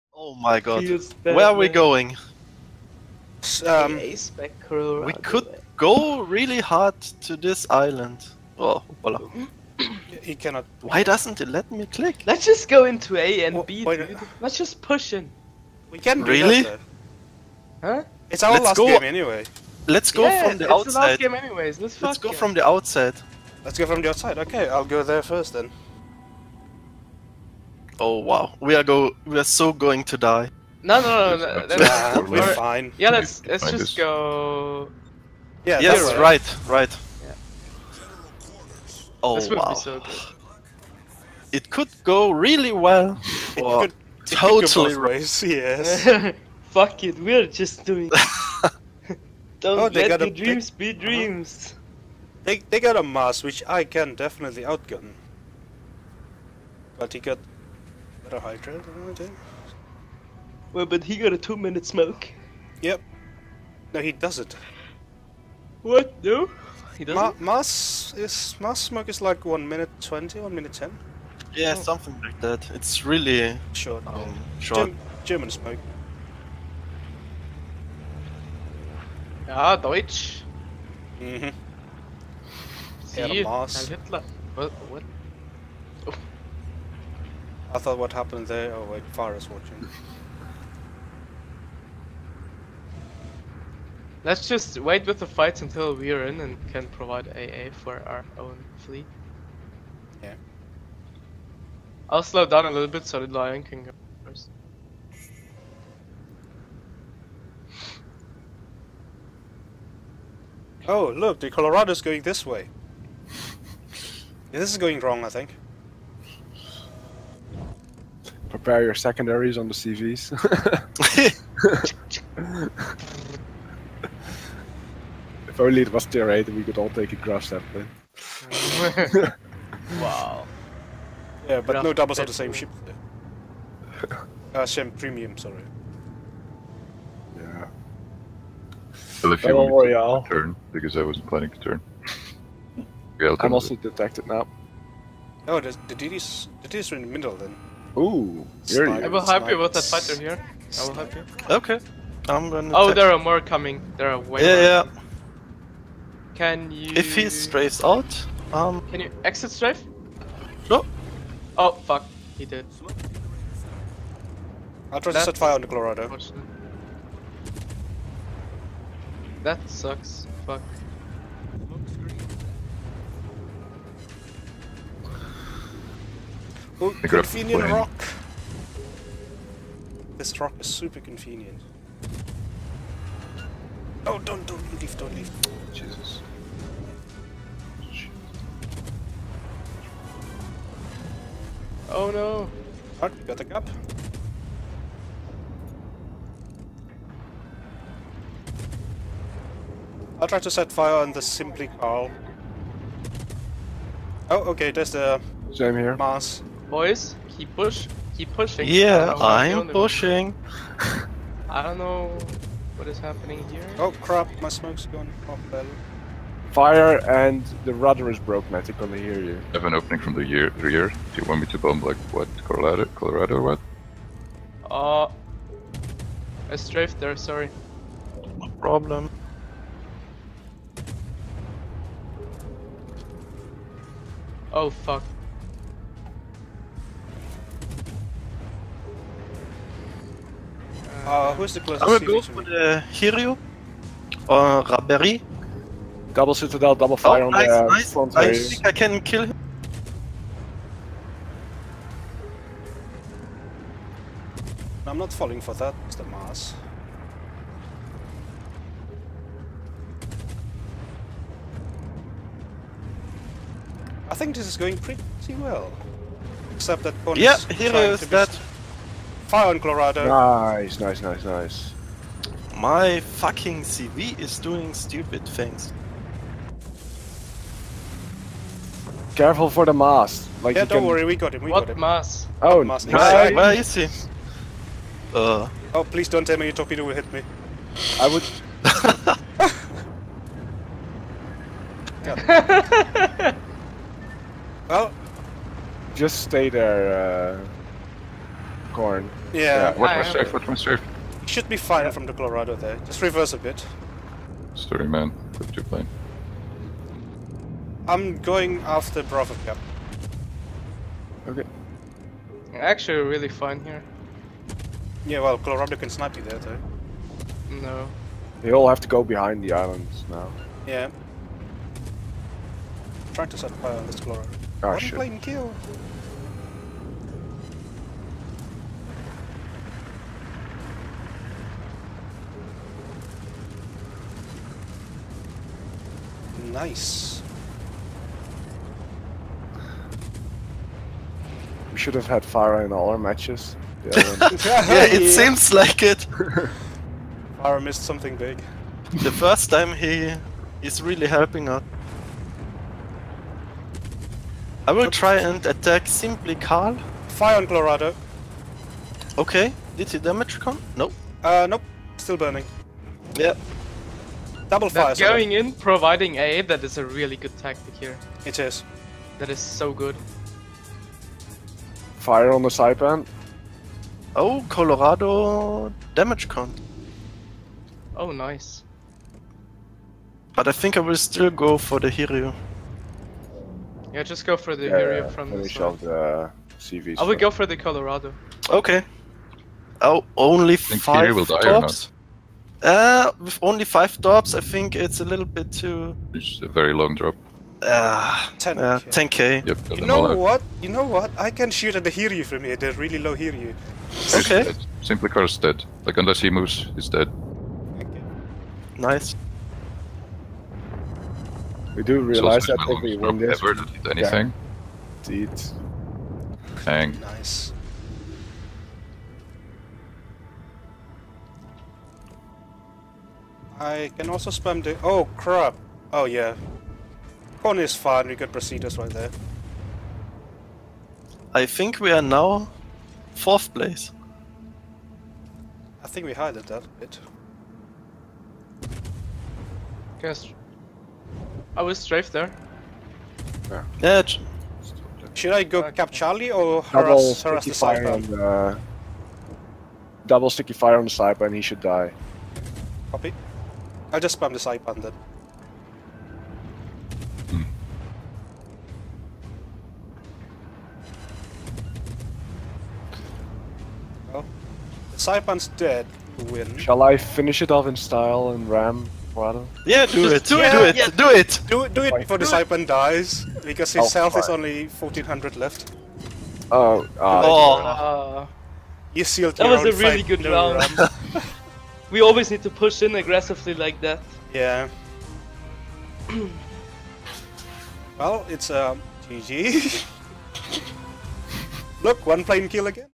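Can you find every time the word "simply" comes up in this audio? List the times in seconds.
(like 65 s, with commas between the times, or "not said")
201 s, 355 s, 404 s.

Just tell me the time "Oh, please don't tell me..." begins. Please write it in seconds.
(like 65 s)
285 s.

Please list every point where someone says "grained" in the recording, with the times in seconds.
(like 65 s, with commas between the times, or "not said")
not said.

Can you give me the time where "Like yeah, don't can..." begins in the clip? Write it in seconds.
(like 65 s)
280 s.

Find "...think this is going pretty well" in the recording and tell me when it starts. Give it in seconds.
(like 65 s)
264 s.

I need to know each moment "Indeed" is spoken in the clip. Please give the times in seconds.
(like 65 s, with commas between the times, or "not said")
415 s.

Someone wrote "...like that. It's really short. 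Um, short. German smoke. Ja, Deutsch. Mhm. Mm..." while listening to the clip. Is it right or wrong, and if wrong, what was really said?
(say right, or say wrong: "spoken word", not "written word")
right.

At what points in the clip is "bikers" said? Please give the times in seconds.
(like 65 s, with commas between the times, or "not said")
not said.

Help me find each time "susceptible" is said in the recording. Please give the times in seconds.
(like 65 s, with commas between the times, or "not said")
not said.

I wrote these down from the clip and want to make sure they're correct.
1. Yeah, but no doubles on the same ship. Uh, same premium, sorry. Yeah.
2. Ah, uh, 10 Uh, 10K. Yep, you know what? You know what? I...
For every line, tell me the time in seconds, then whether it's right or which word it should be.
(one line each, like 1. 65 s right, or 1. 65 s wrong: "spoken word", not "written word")
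1. 131 s right
2. 397 s right.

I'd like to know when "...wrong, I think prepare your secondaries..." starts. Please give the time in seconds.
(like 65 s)
114 s.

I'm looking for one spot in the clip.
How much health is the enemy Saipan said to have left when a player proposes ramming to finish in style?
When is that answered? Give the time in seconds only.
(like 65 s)
474 s.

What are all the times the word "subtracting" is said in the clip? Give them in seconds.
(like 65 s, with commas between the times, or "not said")
not said.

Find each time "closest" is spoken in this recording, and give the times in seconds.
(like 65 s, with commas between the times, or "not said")
241 s.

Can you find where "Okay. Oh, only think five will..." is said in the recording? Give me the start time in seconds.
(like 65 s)
388 s.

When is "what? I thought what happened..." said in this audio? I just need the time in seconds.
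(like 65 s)
84 s.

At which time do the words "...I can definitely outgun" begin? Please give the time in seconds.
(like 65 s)
53 s.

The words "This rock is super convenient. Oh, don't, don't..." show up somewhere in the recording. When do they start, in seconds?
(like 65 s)
180 s.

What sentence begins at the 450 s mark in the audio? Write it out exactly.
double sticky fire on the sniper and he should die.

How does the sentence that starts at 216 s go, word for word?
Fire and the rudder is broken, I think I hear you.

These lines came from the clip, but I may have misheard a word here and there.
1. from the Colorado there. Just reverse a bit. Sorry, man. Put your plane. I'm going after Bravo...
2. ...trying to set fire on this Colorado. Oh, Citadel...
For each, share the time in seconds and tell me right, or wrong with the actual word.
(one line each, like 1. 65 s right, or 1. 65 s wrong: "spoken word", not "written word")
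1. 301 s right
2. 323 s wrong: "One", not "Citadel".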